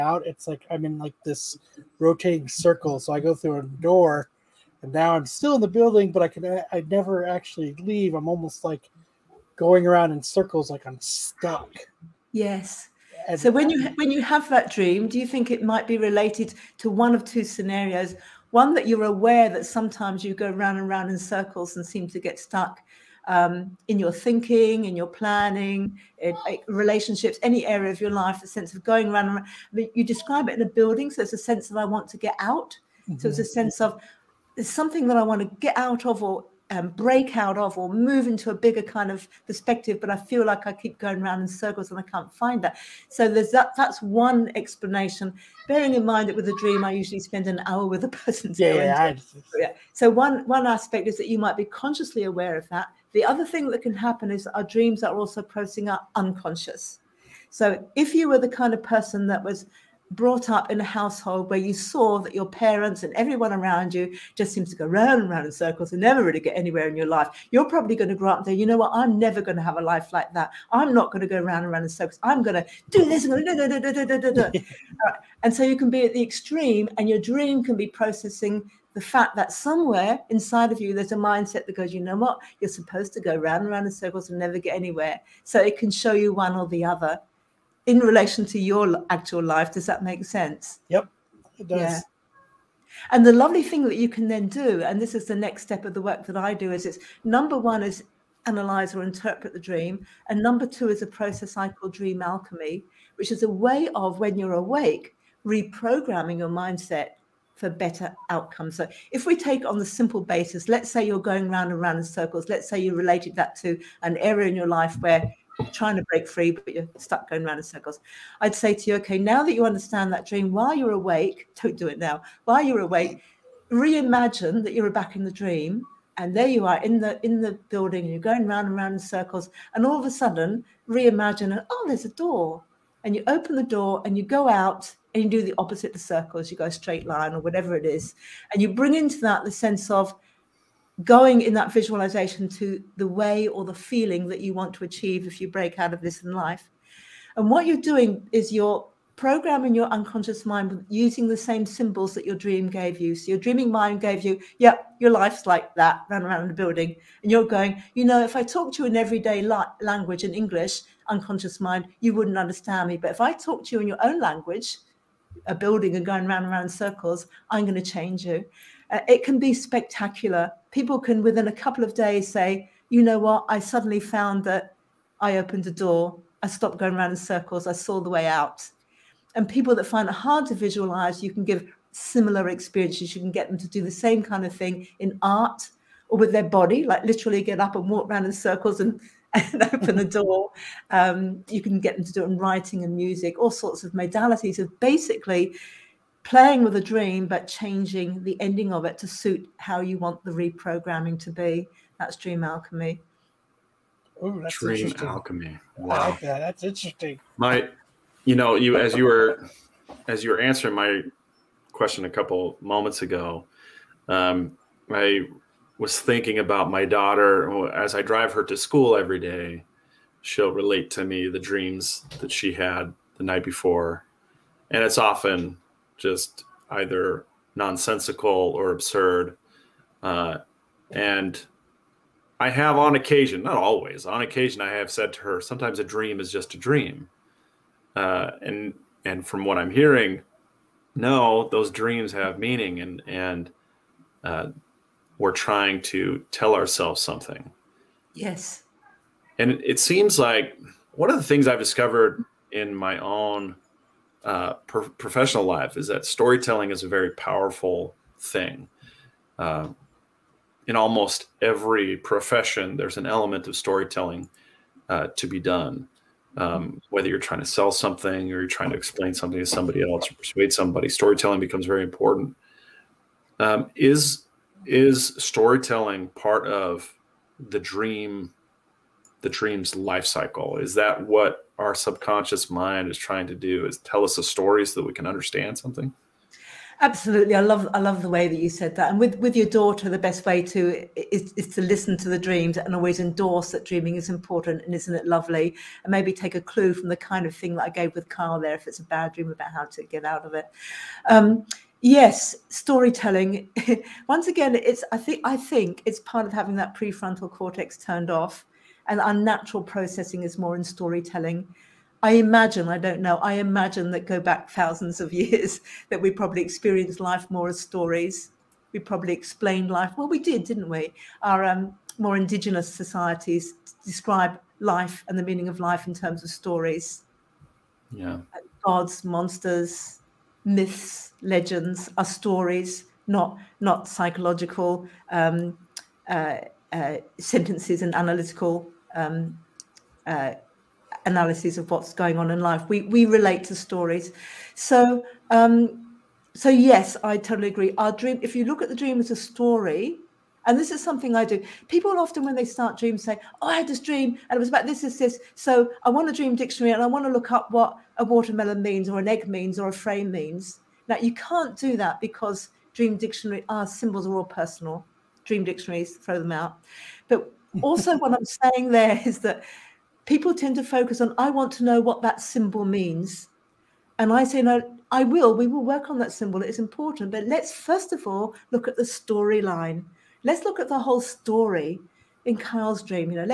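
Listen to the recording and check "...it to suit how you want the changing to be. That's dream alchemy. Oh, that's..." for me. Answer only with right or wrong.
wrong.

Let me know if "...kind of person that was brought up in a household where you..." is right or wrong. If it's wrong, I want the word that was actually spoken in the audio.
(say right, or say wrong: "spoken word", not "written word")
right.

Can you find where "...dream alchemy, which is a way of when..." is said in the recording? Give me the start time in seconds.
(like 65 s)
101 s.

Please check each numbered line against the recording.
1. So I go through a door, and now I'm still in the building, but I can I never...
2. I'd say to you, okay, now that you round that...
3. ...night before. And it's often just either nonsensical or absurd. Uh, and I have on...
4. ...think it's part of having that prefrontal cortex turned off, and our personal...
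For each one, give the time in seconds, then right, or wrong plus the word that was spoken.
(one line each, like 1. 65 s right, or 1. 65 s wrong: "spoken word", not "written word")
1. 2 s right
2. 118 s wrong: "understand", not "round"
3. 223 s right
4. 305 s wrong: "natural", not "personal".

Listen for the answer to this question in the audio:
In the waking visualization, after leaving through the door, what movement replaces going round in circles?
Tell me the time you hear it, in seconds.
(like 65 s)
136 s.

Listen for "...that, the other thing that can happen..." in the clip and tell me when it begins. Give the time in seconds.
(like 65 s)
52 s.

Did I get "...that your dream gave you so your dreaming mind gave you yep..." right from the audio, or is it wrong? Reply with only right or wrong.
right.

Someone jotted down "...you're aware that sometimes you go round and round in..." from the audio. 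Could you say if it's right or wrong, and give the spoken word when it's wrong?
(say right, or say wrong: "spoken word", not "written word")
right.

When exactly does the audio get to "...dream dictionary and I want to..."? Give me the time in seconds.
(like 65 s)
356 s.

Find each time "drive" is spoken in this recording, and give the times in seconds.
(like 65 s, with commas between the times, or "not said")
218 s.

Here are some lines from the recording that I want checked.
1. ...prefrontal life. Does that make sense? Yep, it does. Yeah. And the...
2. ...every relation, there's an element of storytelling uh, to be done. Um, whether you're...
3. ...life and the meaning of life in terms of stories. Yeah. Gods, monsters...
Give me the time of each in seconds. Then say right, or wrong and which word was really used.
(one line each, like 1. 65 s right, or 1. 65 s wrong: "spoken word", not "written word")
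1. 89 s wrong: "actual", not "prefrontal"
2. 261 s wrong: "profession", not "relation"
3. 324 s right.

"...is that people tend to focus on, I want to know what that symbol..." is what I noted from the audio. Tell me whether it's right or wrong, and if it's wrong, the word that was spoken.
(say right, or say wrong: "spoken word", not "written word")
right.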